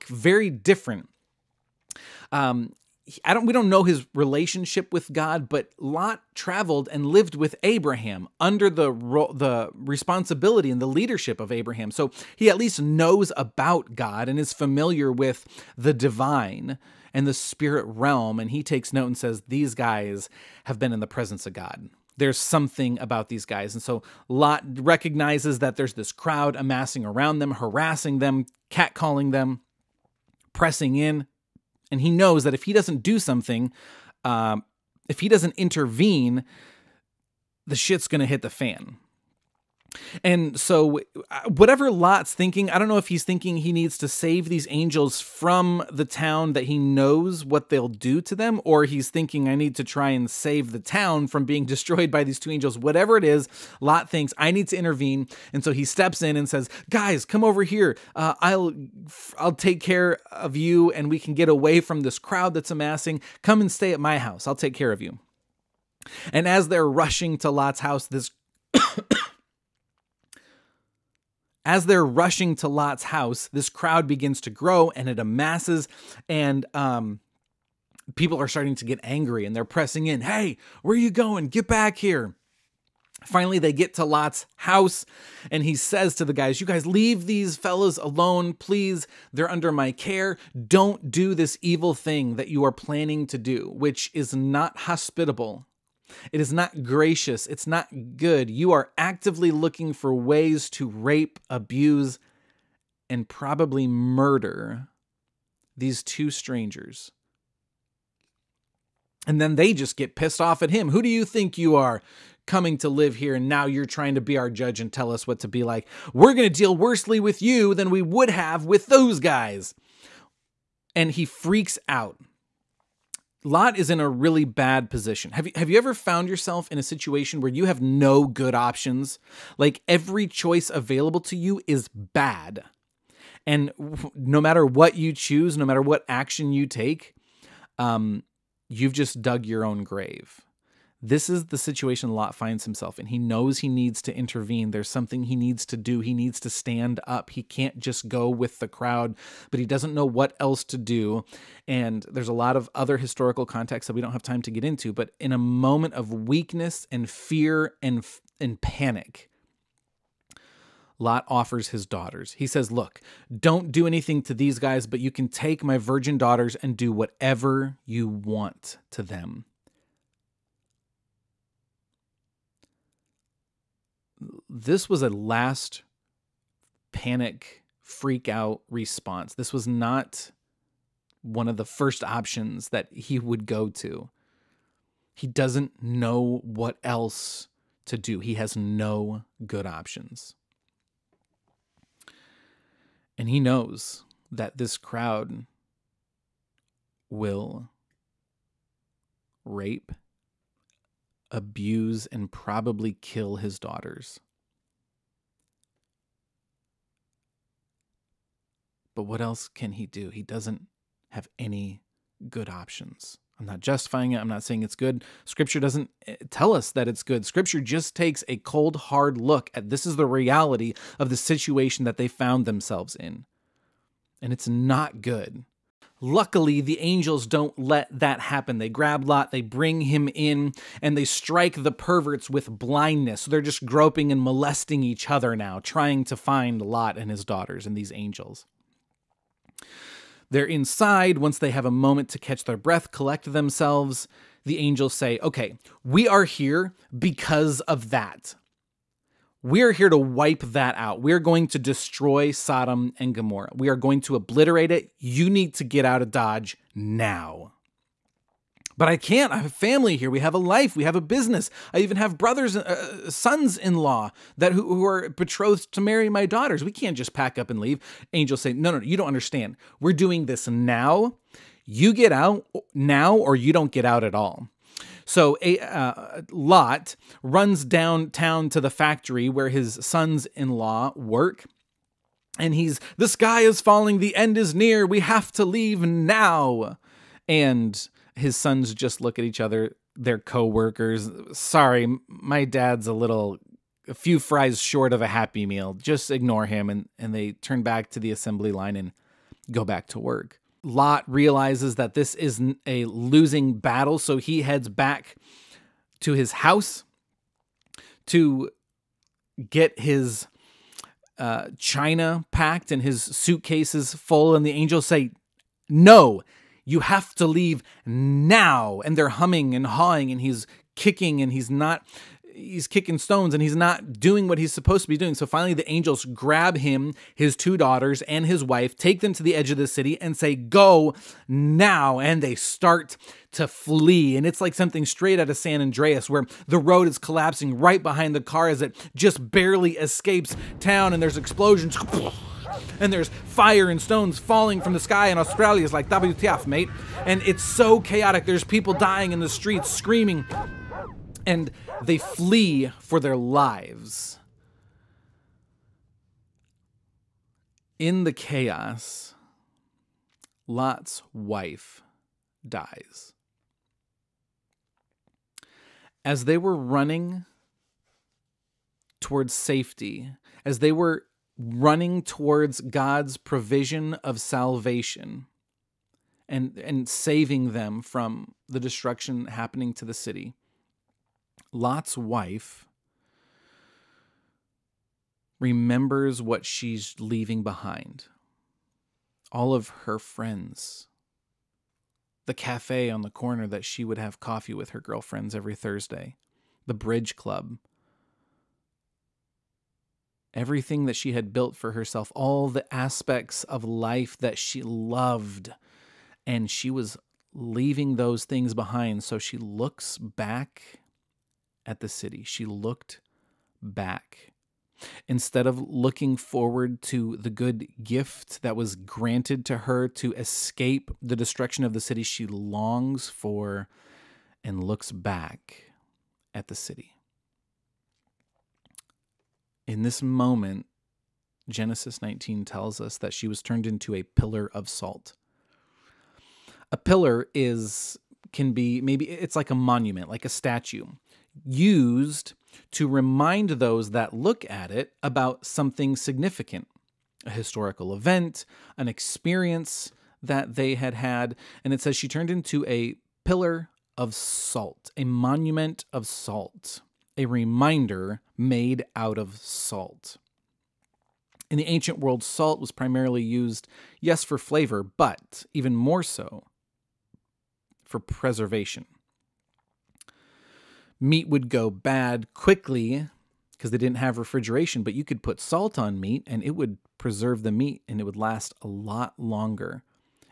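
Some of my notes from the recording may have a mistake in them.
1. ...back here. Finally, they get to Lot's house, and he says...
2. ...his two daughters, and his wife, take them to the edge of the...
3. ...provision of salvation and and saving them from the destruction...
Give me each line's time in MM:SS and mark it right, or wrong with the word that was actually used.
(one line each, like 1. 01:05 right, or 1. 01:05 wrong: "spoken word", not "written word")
1. 01:21 right
2. 05:27 right
3. 06:13 right.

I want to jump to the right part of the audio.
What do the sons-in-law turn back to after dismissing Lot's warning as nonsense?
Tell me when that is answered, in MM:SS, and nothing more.
04:58.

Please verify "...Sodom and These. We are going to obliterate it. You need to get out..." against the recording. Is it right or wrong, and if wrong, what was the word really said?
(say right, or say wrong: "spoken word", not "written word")
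wrong: "Gomorrah", not "These".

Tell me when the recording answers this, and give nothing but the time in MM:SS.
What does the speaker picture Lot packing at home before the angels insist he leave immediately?
05:11.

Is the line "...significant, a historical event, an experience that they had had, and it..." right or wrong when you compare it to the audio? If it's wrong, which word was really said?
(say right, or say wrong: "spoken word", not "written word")
right.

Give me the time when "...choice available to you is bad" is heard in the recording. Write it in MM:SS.
02:10.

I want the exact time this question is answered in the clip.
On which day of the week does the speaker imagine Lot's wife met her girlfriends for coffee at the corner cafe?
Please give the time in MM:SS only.
06:35.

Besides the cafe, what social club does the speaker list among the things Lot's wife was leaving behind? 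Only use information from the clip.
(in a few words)
bridge club.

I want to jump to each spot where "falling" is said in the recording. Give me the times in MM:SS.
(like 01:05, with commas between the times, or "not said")
04:43, 05:44.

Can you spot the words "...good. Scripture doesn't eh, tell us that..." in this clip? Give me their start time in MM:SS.
03:34.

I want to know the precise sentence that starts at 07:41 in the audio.
In the ancient world, salt was primarily used, yes, for flavor, but even more so for preservation.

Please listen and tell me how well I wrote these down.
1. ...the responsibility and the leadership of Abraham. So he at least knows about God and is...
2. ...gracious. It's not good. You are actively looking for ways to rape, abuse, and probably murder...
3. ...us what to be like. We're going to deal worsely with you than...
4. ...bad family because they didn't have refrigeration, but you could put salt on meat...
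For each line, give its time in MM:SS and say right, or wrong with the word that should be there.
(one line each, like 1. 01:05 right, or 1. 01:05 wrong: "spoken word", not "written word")
1. 00:09 right
2. 01:36 right
3. 01:55 right
4. 07:51 wrong: "quickly", not "family".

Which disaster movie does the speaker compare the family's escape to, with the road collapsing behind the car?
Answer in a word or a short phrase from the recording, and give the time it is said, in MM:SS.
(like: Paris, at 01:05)
San Andreas, at 05:35.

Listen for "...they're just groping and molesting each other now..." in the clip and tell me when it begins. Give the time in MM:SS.
03:53.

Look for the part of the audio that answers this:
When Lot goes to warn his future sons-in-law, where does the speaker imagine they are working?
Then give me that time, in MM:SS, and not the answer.
04:38.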